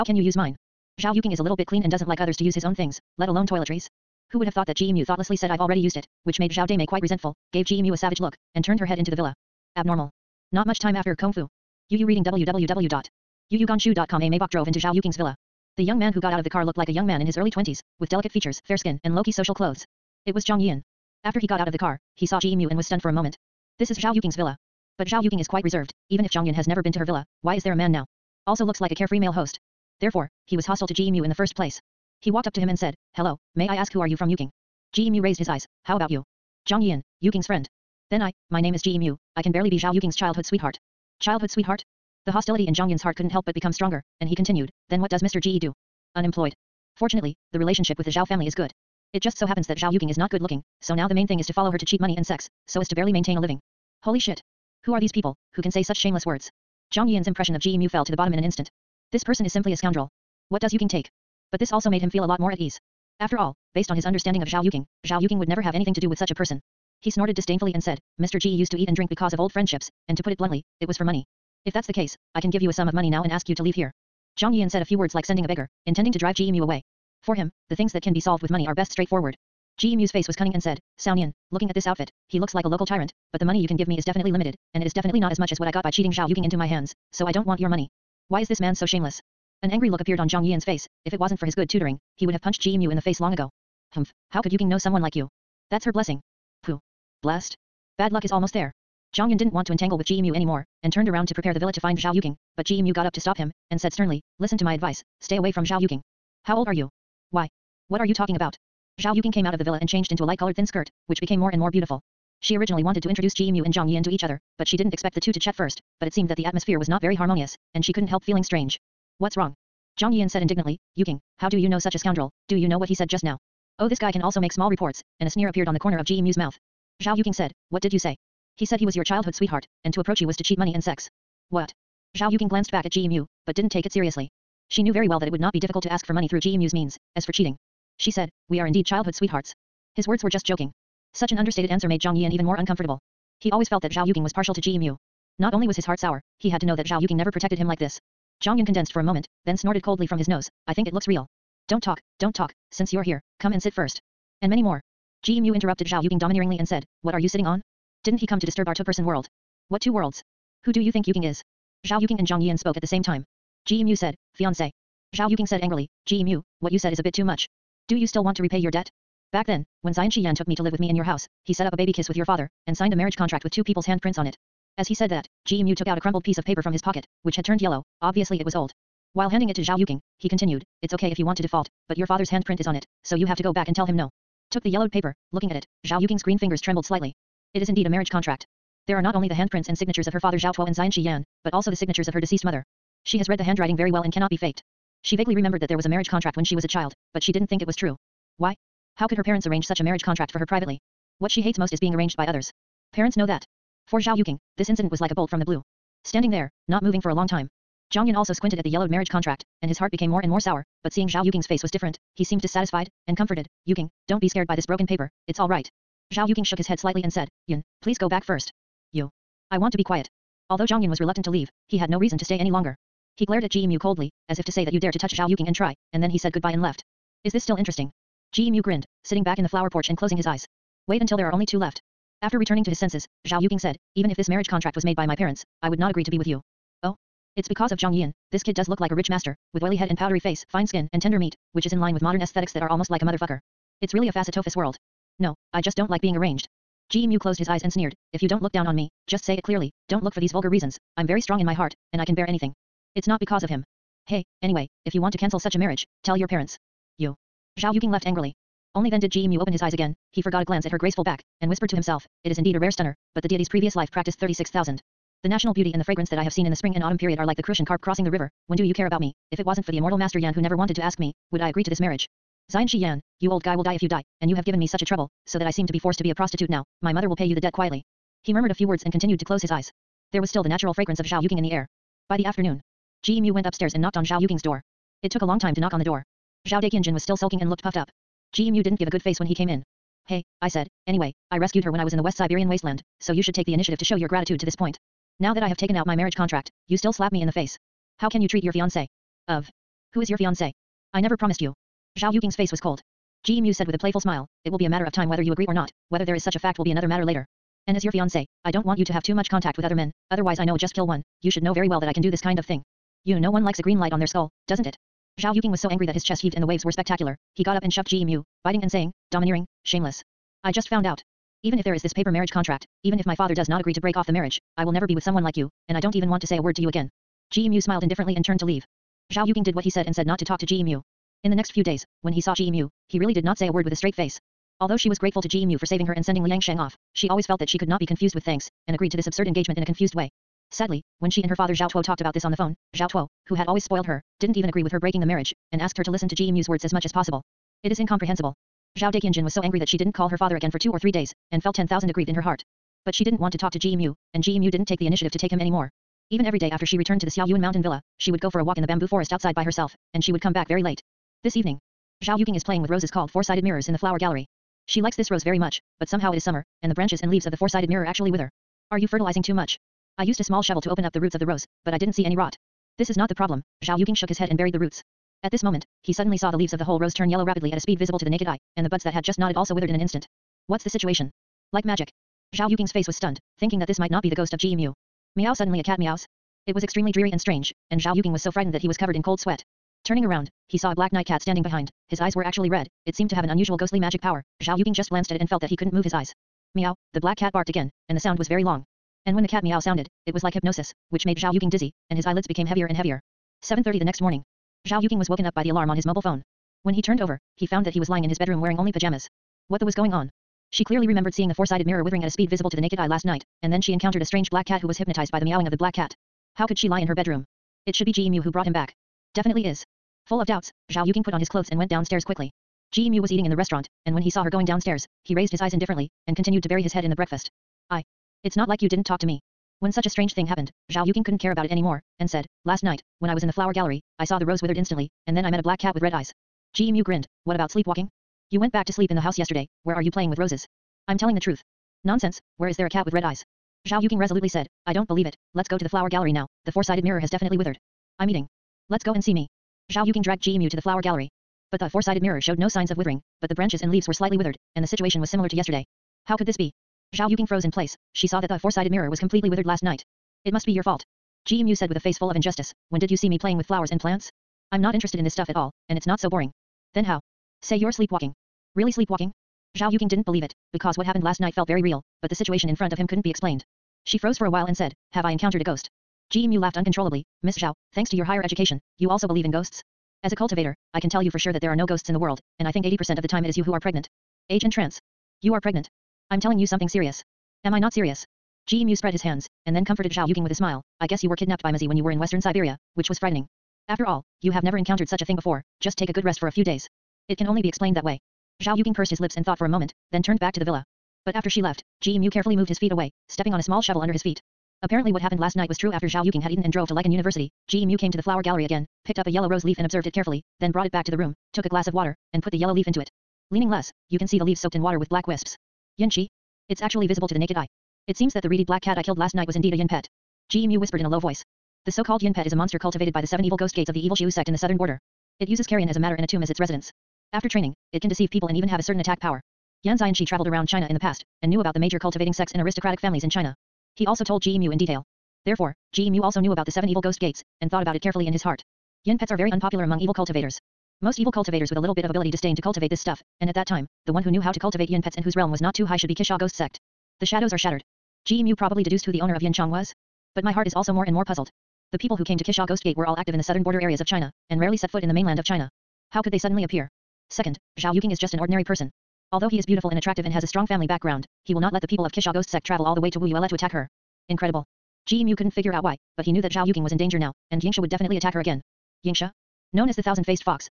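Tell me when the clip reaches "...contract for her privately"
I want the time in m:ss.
3:20.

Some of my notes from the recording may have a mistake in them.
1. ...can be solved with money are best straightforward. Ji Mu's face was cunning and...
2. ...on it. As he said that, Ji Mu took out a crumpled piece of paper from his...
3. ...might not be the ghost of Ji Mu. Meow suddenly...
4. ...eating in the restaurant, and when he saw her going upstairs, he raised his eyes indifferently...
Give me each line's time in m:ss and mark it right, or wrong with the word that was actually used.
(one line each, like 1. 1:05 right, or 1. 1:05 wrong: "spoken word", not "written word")
1. 1:18 right
2. 2:54 right
3. 6:23 right
4. 7:03 wrong: "downstairs", not "upstairs".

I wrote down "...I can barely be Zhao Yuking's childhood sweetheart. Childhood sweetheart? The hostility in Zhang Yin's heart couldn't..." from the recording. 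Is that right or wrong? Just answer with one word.
right.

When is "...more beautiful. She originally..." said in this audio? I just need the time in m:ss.
1:51.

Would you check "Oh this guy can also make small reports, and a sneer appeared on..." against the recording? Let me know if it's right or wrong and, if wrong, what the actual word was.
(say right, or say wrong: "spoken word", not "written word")
right.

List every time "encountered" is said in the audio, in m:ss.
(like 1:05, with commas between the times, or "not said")
6:53, 7:55, 8:14.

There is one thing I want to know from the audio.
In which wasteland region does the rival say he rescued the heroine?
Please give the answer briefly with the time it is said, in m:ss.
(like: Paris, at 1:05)
West Siberian wasteland, at 4:52.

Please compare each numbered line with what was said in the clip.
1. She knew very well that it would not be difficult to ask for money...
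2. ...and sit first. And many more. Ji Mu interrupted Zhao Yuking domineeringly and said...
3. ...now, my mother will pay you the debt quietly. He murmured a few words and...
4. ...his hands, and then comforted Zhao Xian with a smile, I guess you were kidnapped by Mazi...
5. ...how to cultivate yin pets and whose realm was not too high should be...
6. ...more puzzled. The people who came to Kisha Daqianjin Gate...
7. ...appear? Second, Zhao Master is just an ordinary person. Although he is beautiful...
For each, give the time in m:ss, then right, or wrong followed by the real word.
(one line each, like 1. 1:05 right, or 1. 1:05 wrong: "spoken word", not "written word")
1. 2:14 right
2. 2:33 right
3. 4:36 right
4. 8:08 wrong: "Yuking", not "Xian"
5. 9:04 right
6. 9:10 wrong: "Ghost", not "Daqianjin"
7. 9:16 wrong: "Yuking", not "Master".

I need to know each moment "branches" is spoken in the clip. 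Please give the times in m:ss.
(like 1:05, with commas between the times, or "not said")
6:06, 7:33.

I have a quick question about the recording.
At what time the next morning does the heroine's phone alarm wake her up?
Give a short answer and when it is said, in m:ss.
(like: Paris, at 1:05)
7:30, at 6:43.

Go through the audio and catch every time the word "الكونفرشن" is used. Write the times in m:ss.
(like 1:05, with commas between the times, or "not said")
not said.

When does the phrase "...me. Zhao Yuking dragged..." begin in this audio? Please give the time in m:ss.
7:29.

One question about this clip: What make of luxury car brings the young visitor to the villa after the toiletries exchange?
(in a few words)
Maybach.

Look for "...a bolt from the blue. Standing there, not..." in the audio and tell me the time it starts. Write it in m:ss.
3:25.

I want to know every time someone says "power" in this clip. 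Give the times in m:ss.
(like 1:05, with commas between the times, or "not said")
6:34, 8:48.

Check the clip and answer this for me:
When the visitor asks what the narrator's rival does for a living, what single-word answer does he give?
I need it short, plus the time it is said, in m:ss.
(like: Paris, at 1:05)
Unemployed, at 0:46.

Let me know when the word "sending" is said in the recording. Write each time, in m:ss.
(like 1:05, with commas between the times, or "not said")
1:15, 5:36.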